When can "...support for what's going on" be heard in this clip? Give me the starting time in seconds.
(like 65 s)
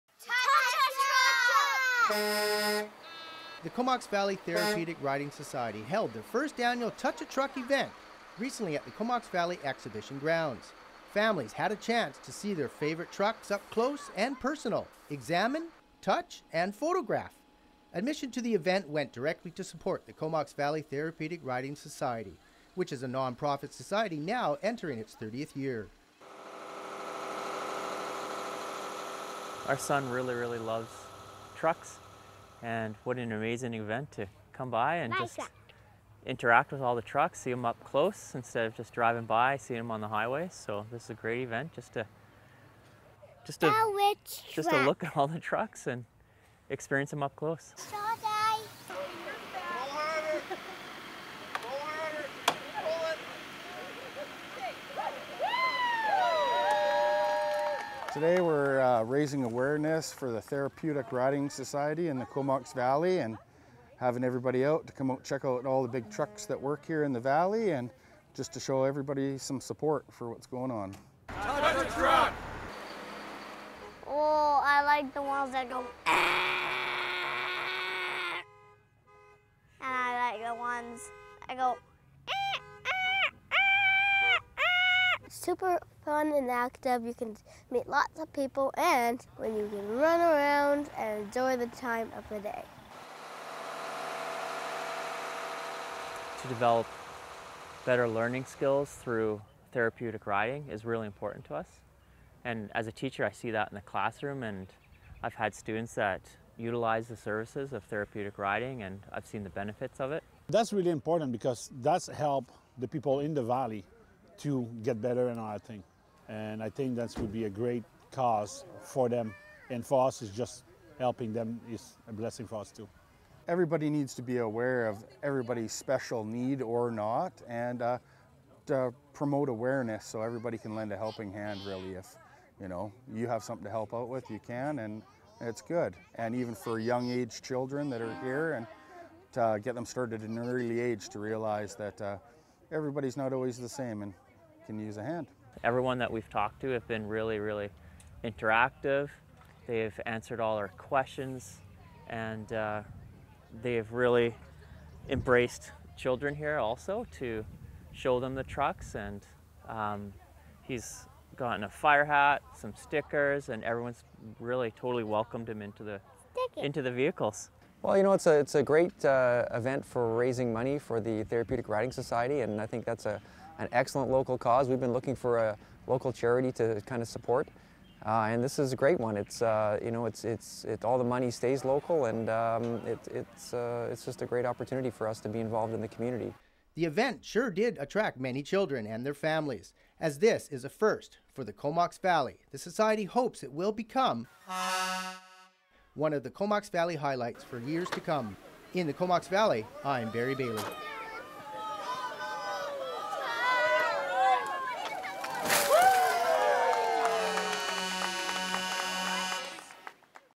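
69 s.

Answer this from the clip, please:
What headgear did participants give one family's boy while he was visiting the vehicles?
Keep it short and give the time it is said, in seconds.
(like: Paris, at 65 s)
fire hat, at 161 s.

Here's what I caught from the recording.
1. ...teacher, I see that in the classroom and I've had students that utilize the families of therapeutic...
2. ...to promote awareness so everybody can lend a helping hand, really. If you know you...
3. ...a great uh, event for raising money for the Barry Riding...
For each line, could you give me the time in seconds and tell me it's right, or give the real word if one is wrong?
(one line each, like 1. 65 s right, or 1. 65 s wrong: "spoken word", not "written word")
1. 102 s wrong: "services", not "families"
2. 128 s right
3. 168 s wrong: "Therapeutic", not "Barry".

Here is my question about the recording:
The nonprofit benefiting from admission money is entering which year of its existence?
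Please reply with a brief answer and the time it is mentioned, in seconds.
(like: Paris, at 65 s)
30th, at 25 s.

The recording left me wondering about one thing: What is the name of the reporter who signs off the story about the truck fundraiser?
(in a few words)
Barry Bailey.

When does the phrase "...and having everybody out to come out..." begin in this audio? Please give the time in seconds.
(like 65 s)
63 s.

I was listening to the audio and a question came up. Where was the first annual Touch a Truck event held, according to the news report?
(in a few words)
Comox Valley Exhibition Grounds.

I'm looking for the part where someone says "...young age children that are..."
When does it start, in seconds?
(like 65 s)
136 s.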